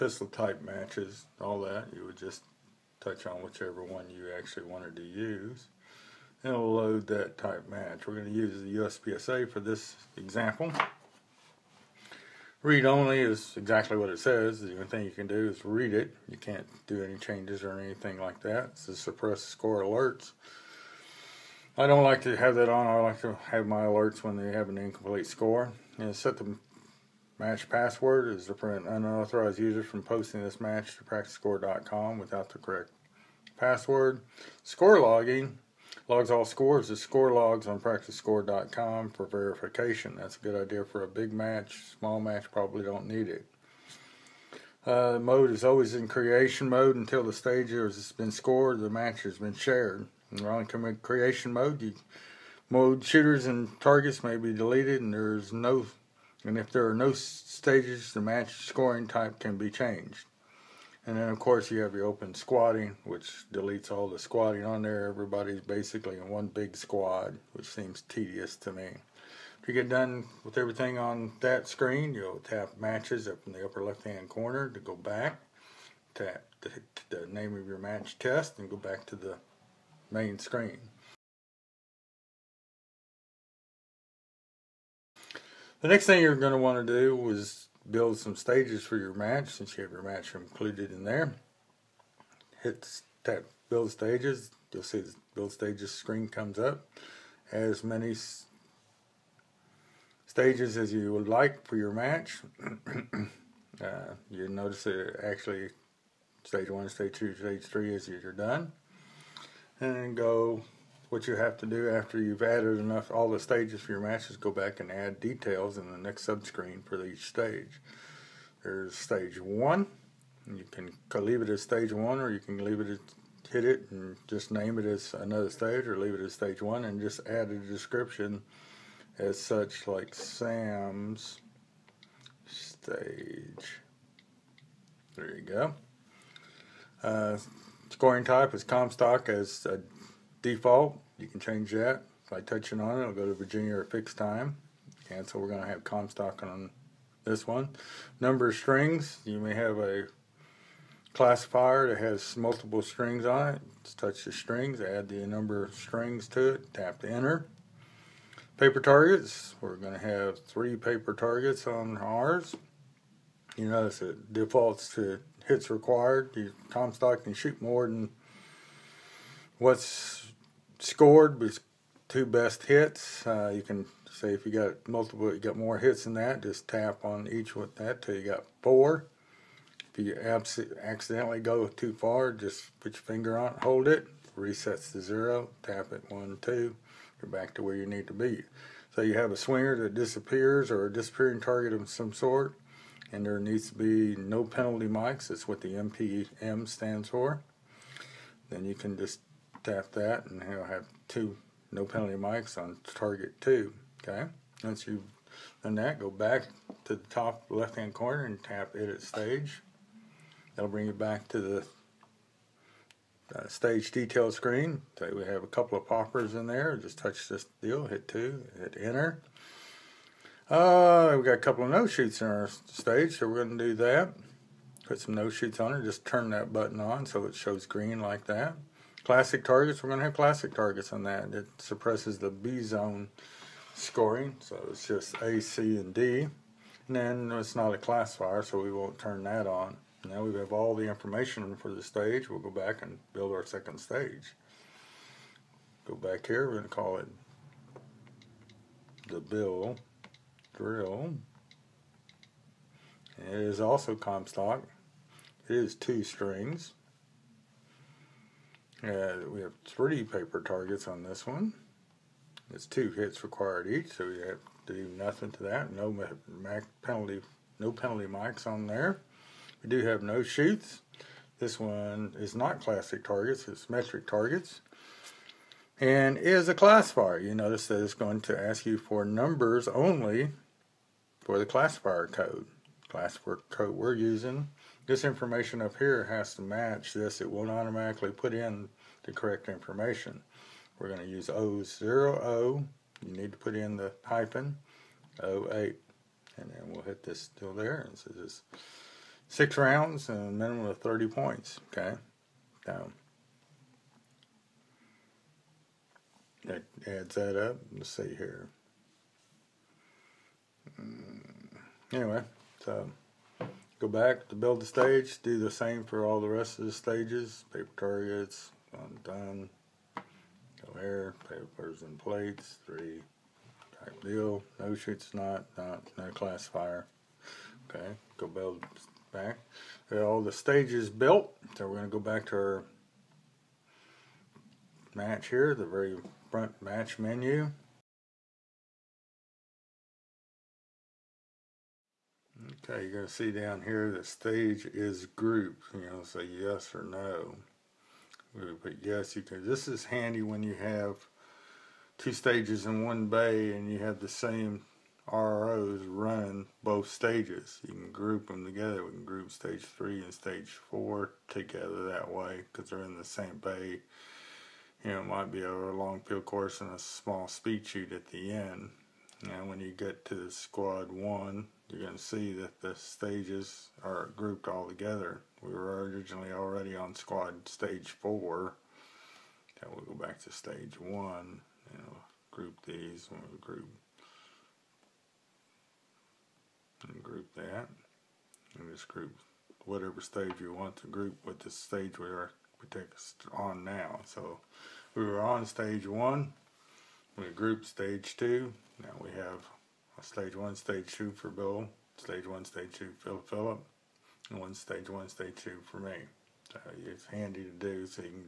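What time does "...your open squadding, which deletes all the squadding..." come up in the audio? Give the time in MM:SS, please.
01:01.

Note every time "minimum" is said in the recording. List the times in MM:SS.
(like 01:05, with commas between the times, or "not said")
05:00.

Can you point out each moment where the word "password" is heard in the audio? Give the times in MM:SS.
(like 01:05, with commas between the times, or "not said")
00:27, 00:33.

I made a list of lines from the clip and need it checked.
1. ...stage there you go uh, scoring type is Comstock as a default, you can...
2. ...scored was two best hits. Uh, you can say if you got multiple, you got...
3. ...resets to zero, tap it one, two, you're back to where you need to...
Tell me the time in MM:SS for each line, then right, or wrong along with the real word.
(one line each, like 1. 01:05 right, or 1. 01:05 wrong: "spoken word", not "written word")
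1. 02:12 right
2. 02:50 right
3. 03:04 right.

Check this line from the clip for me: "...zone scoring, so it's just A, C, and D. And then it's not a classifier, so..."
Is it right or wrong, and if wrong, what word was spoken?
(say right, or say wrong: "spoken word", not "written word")
right.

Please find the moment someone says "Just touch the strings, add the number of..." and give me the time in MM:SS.
02:33.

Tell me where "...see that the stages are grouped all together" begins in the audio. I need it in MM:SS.
06:12.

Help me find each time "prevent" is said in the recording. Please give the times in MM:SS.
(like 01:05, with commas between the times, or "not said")
00:28.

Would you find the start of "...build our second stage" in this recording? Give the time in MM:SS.
04:03.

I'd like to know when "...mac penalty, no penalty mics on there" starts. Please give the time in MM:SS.
04:26.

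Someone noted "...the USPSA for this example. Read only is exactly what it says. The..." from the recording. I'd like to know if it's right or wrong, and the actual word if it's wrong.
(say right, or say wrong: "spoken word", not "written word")
right.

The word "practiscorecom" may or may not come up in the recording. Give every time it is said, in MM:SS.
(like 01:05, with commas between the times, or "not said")
00:31, 00:37.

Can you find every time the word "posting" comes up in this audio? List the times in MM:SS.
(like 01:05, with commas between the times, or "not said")
00:30.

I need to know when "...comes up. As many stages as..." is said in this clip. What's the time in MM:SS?
01:36.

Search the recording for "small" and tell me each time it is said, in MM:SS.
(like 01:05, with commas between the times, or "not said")
00:41, 06:06.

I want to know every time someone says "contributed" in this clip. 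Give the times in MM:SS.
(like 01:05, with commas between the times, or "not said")
not said.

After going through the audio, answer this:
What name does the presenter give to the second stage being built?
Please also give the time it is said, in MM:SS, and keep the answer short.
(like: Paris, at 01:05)
the bill drill, at 04:09.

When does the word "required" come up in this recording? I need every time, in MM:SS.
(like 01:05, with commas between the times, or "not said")
02:45, 04:23.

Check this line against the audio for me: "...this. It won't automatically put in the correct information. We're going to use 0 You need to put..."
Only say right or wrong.
right.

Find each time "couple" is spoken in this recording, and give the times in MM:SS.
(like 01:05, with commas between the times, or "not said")
03:35, 03:41.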